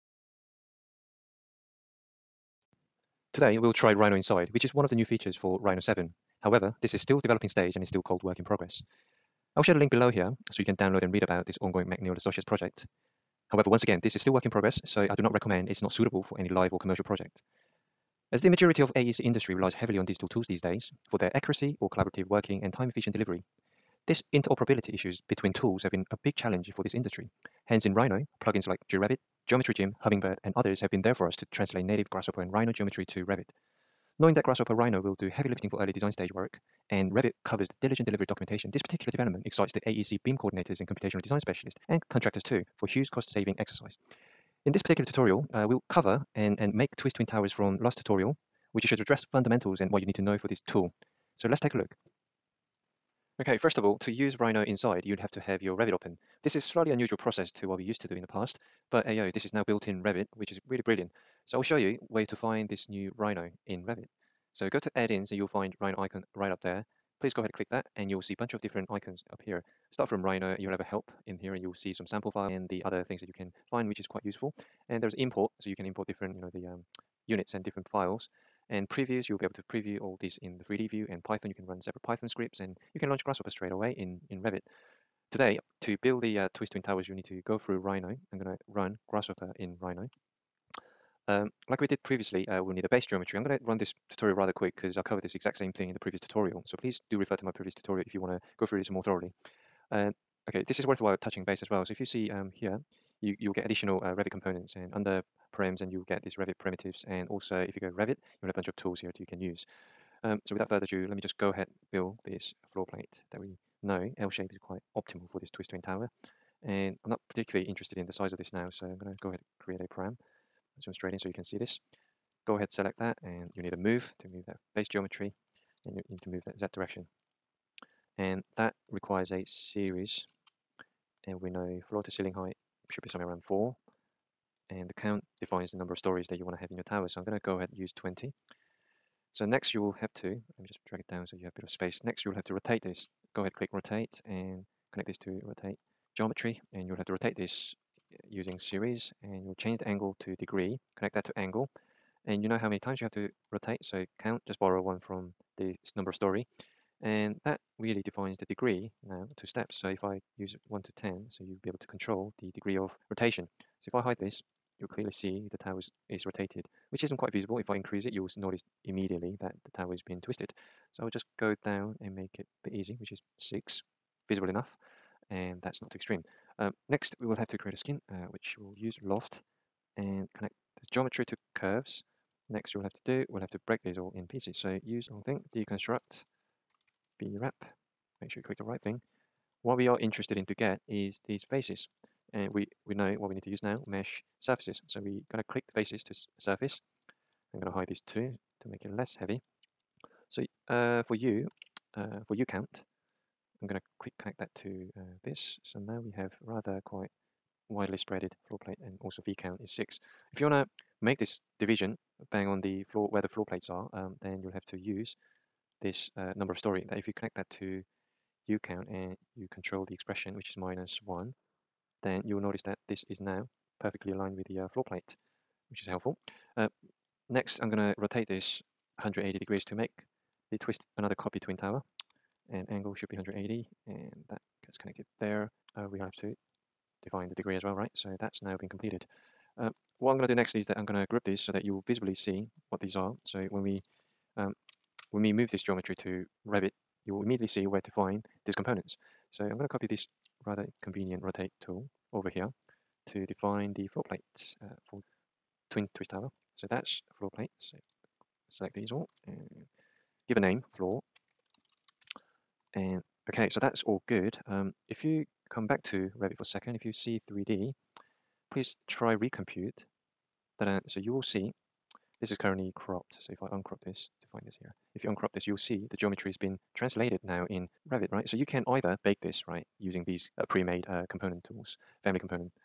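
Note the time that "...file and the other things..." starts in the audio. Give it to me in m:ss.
1:12.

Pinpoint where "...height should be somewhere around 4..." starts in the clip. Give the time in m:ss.
2:12.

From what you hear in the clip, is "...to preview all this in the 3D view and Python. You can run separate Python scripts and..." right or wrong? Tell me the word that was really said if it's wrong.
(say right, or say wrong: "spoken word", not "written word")
right.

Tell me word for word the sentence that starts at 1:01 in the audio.
So I'll show you where to find this new Rhino in Revit.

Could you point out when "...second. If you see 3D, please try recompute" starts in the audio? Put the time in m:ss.
4:26.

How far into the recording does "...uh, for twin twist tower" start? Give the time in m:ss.
4:14.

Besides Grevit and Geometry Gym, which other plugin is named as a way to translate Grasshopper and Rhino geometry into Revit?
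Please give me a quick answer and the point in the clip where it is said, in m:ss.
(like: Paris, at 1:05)
Hummingbird, at 0:29.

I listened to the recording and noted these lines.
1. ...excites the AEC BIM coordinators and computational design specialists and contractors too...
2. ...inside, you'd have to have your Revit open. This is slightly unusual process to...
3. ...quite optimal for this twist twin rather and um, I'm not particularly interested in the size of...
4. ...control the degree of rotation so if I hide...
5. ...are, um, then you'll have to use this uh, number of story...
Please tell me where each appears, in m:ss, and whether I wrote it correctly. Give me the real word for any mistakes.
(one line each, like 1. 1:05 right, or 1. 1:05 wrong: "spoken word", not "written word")
1. 0:39 right
2. 0:54 right
3. 1:54 wrong: "tower", not "rather"
4. 2:41 right
5. 3:33 right.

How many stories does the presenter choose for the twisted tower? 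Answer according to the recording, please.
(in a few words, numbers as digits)
20.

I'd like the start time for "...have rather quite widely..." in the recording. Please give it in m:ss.
3:26.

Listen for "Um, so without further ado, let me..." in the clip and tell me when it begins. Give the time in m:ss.
1:50.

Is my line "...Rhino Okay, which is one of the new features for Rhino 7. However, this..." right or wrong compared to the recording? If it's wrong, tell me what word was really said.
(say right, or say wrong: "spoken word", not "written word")
wrong: "Inside", not "Okay".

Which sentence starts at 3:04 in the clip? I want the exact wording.
So use wrong thing, deconstruct, Brep.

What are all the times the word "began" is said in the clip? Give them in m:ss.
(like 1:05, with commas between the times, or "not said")
not said.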